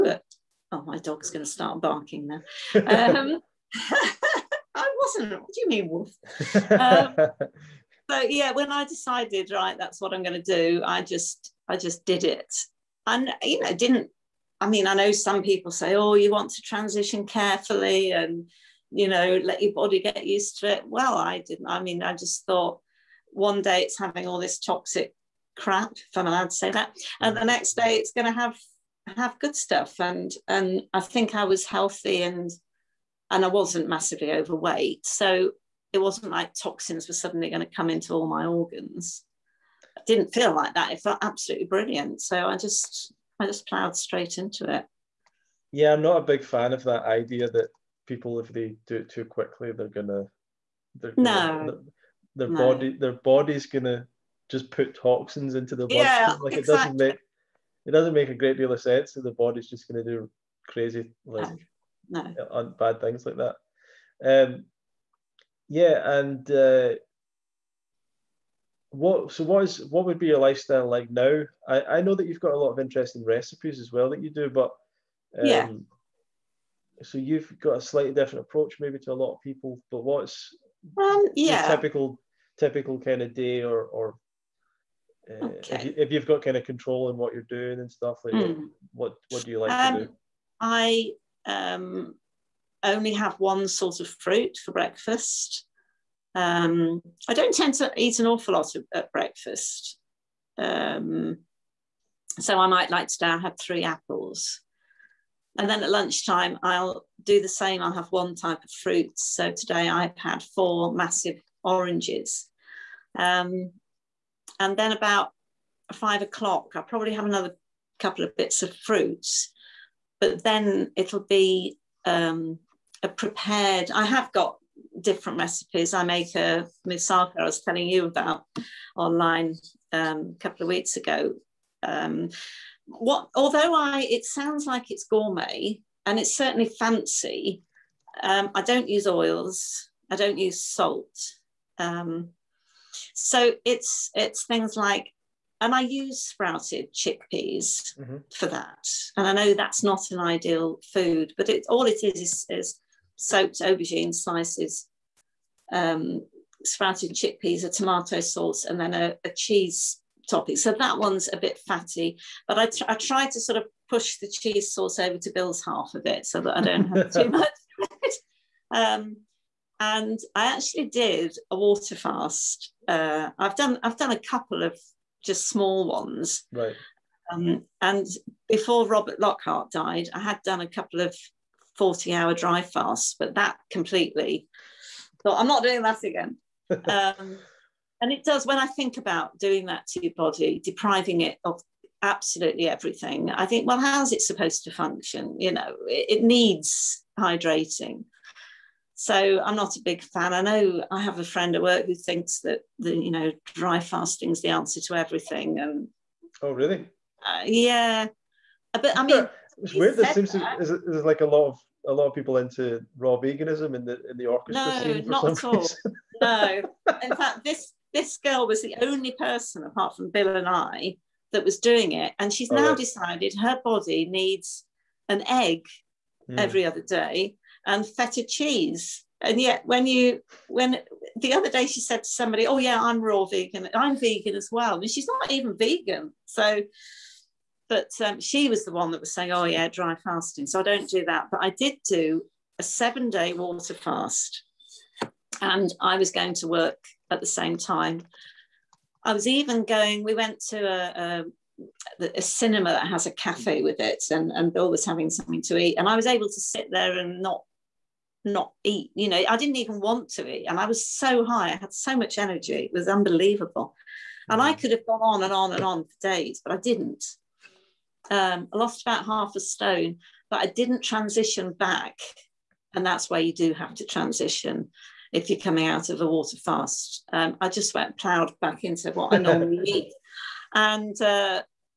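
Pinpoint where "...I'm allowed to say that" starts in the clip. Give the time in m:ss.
0:26.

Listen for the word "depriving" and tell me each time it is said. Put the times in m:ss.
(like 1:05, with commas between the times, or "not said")
3:10.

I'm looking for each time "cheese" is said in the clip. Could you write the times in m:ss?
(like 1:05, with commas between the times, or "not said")
2:39, 2:44, 3:48.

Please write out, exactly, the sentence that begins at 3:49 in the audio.
And yet, when you, when the other day she said to somebody, Oh, yeah, I'm raw vegan, I'm vegan as well.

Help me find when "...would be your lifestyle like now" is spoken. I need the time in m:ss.
1:10.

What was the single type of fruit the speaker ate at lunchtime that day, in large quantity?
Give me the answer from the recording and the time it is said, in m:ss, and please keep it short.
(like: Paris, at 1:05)
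Oranges, at 1:50.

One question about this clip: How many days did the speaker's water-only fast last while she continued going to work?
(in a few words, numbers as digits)
7.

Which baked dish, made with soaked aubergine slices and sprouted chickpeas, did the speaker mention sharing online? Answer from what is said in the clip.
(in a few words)
Moussaka.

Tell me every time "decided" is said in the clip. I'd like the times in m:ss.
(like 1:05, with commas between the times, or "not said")
0:08, 3:42.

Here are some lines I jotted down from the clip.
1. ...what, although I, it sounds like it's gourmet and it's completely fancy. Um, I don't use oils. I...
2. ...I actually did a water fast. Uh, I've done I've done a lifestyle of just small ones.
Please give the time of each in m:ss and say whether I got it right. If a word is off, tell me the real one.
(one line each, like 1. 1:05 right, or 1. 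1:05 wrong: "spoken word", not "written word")
1. 2:12 wrong: "certainly", not "completely"
2. 2:50 wrong: "couple", not "lifestyle".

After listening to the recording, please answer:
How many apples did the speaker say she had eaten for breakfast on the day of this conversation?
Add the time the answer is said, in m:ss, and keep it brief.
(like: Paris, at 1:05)
3, at 1:43.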